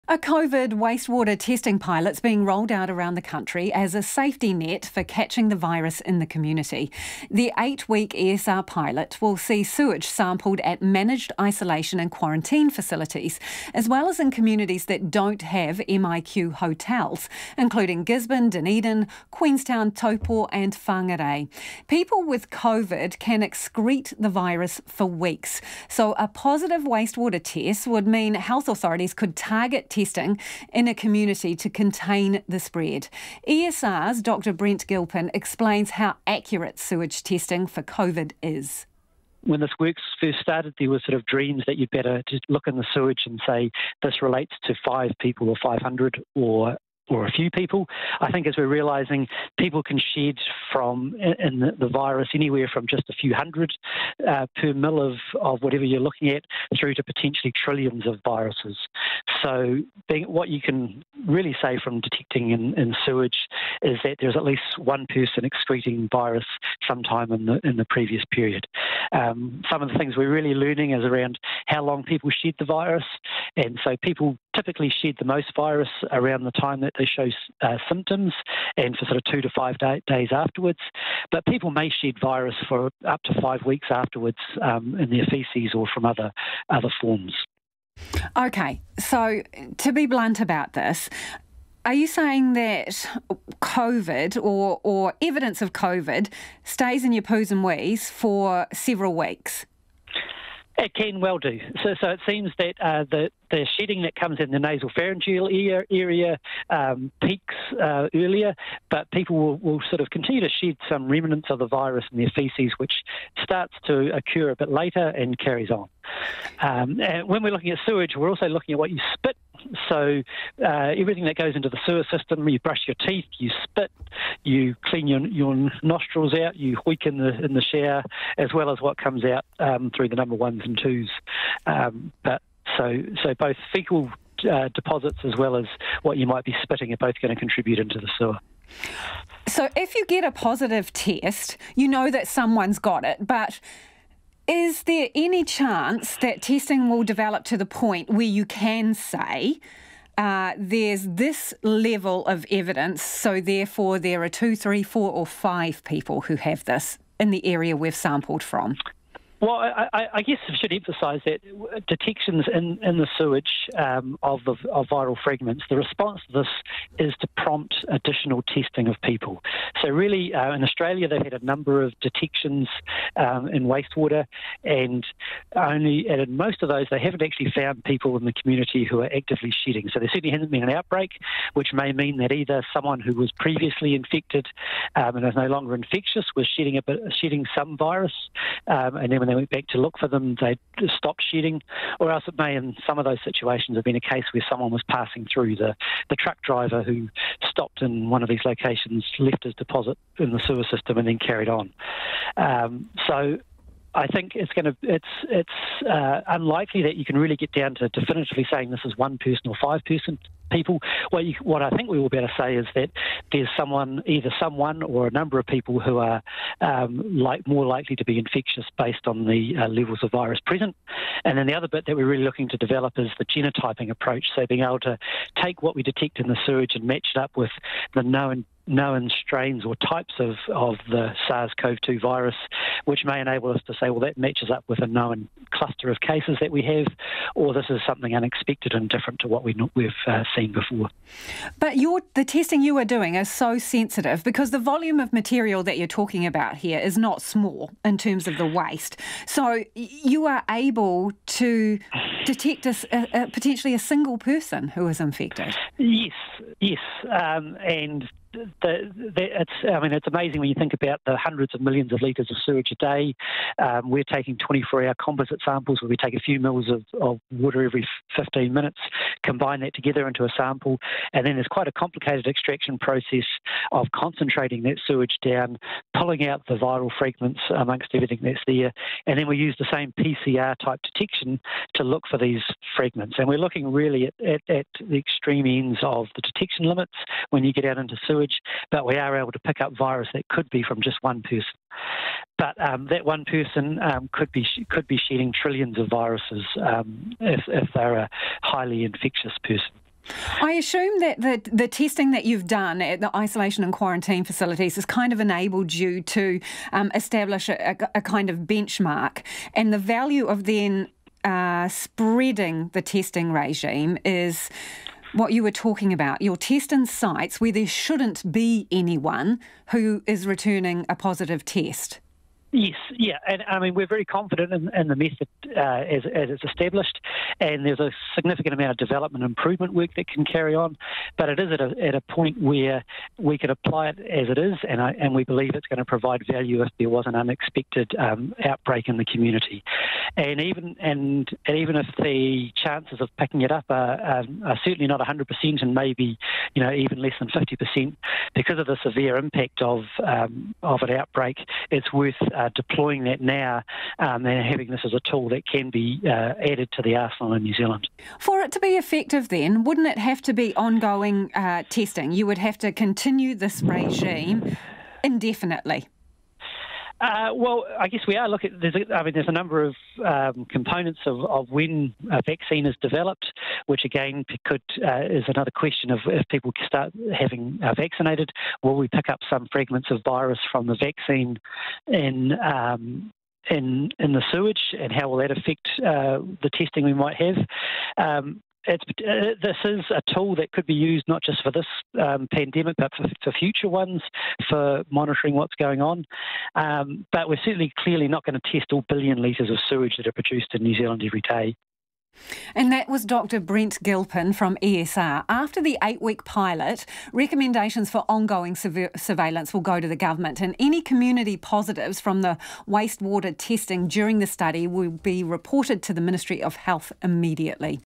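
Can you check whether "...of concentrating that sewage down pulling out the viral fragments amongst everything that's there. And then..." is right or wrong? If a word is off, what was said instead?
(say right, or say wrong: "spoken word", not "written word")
right.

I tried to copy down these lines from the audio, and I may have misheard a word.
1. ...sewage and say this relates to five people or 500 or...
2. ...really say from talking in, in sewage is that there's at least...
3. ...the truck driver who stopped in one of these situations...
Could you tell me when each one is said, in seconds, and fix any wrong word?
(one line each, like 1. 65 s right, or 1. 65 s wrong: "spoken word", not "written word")
1. 42 s right
2. 61 s wrong: "detecting", not "talking"
3. 196 s wrong: "locations", not "situations".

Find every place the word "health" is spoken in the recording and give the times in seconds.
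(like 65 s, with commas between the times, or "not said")
28 s, 416 s.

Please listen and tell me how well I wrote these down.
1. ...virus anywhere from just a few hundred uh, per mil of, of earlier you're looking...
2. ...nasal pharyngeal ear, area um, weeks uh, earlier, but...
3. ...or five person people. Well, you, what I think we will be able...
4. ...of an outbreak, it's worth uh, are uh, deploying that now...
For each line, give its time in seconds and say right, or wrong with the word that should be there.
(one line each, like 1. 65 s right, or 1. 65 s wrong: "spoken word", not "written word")
1. 51 s wrong: "whatever", not "earlier"
2. 104 s wrong: "peaks", not "weeks"
3. 209 s right
4. 350 s right.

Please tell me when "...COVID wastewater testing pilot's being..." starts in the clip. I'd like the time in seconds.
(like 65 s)
0 s.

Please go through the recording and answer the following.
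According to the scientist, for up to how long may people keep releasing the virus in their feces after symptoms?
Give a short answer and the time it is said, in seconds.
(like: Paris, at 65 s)
5 weeks, at 83 s.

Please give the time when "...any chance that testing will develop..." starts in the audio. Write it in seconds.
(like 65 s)
145 s.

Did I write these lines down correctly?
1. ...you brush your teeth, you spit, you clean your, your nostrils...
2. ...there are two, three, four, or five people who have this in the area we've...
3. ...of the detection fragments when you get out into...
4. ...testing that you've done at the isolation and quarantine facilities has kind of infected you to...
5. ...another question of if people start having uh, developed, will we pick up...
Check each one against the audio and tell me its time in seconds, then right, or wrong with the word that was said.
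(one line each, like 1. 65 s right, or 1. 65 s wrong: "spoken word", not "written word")
1. 122 s right
2. 153 s right
3. 285 s wrong: "limits", not "fragments"
4. 301 s wrong: "enabled", not "infected"
5. 375 s wrong: "vaccinated", not "developed".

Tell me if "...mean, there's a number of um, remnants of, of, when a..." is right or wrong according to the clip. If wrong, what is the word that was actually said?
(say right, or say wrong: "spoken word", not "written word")
wrong: "components", not "remnants".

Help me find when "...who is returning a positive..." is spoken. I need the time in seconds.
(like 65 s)
319 s.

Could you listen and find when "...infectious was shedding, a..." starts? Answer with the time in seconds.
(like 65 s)
185 s.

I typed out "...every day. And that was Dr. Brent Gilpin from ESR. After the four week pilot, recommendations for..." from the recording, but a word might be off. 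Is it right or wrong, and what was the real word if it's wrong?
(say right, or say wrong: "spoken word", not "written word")
wrong: "eight", not "four".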